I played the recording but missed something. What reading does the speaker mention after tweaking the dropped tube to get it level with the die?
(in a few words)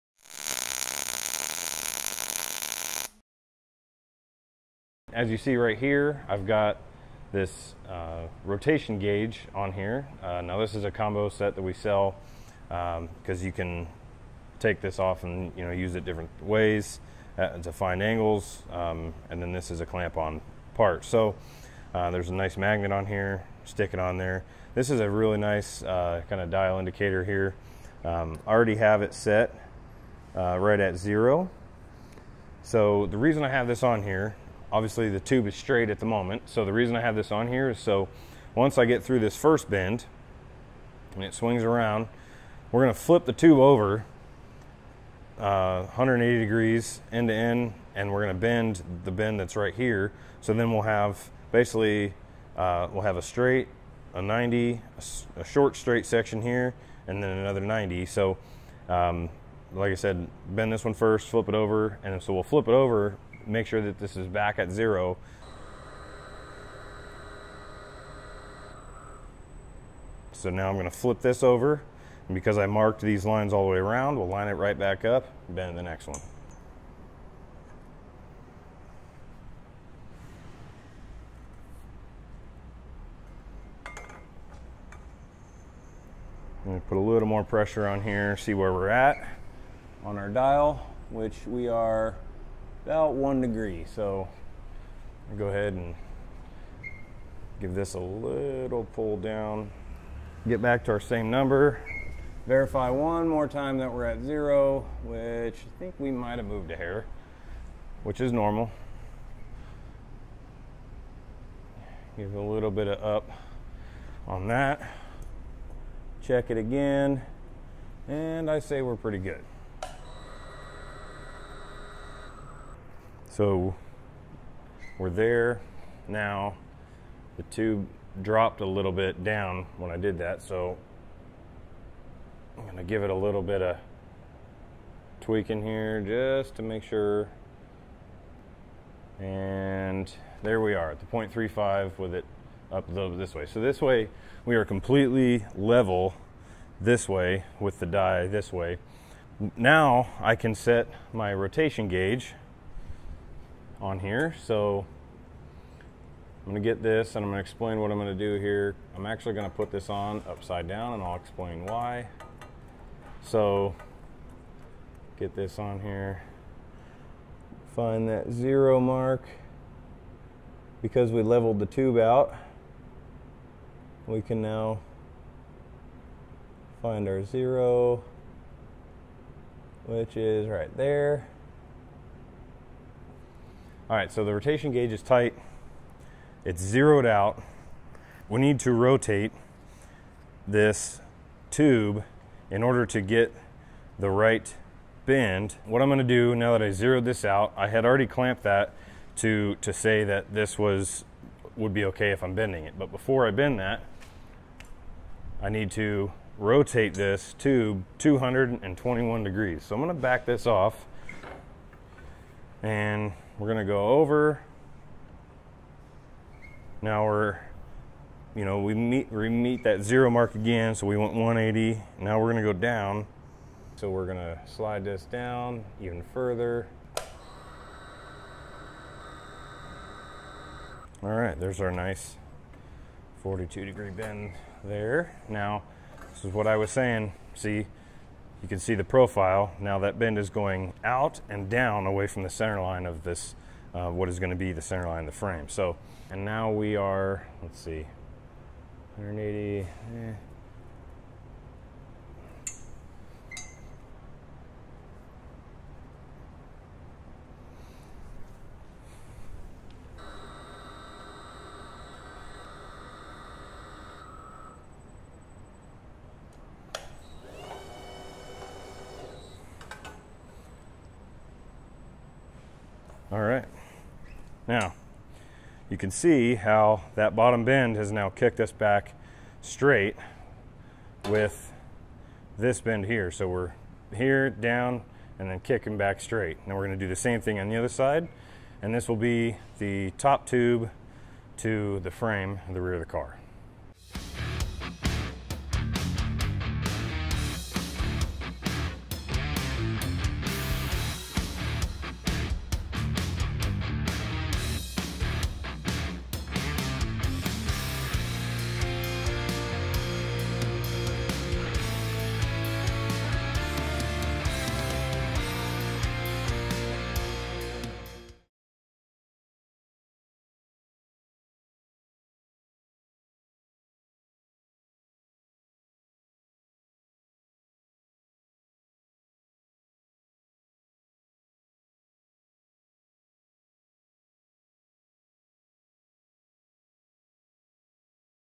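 0.35.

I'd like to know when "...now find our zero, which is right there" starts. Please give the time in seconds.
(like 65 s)
174 s.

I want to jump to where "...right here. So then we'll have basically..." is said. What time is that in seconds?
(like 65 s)
49 s.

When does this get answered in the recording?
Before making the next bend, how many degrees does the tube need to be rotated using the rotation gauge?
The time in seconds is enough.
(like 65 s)
207 s.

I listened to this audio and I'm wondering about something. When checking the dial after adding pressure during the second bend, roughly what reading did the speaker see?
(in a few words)
1 degree.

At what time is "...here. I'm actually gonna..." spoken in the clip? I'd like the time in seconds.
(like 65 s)
158 s.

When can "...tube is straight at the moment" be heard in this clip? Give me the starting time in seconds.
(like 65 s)
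35 s.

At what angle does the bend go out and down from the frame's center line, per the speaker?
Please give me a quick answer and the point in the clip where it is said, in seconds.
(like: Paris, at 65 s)
42 degrees, at 233 s.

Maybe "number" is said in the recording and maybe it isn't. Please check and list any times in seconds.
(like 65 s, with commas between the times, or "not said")
101 s.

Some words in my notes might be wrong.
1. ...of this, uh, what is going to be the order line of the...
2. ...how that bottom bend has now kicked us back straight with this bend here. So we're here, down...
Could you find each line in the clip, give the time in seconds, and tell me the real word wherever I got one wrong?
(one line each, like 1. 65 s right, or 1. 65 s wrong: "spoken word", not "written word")
1. 242 s wrong: "center", not "order"
2. 276 s right.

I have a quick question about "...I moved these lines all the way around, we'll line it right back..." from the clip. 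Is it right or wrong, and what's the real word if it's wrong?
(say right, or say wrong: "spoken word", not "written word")
wrong: "marked", not "moved".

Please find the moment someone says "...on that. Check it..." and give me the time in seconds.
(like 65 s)
114 s.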